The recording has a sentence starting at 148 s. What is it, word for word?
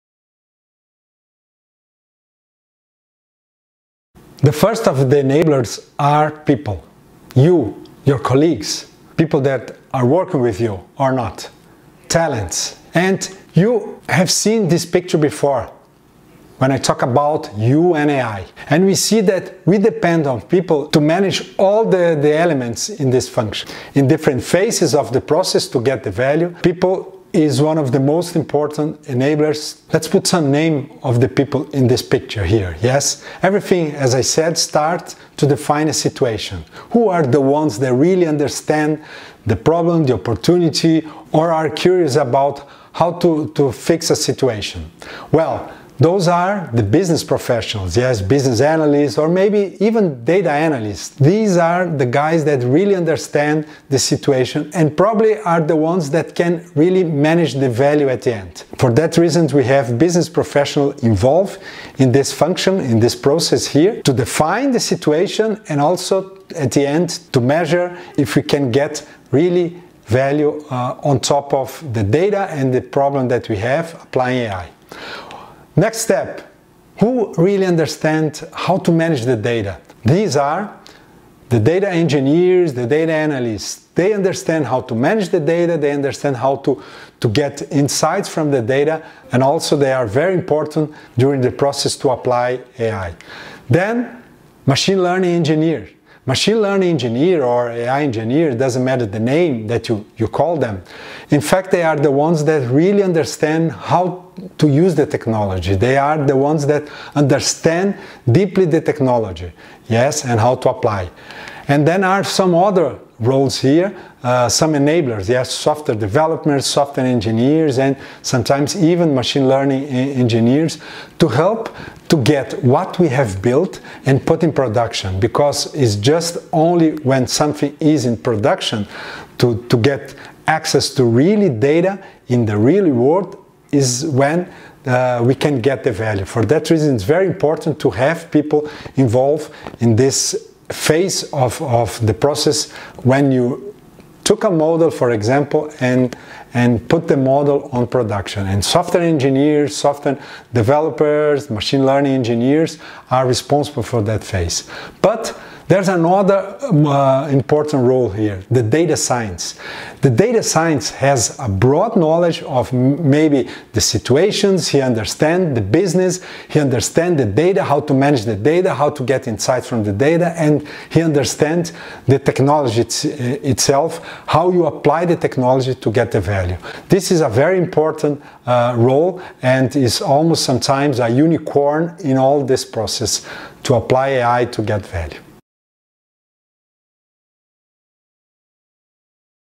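And software engineers, software developers, machine learning engineers are responsible for that phase.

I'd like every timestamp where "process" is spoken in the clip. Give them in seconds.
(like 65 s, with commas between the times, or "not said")
25 s, 63 s, 91 s, 142 s, 182 s.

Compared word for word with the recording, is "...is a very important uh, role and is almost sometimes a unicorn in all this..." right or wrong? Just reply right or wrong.
right.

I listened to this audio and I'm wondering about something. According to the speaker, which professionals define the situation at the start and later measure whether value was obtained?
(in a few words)
Business professionals.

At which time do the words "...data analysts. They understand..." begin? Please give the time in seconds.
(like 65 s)
82 s.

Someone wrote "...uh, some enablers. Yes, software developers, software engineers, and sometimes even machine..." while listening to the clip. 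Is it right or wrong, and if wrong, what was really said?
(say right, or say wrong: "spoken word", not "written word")
right.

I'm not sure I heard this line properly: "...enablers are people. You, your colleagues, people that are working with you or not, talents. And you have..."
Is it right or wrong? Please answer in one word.
right.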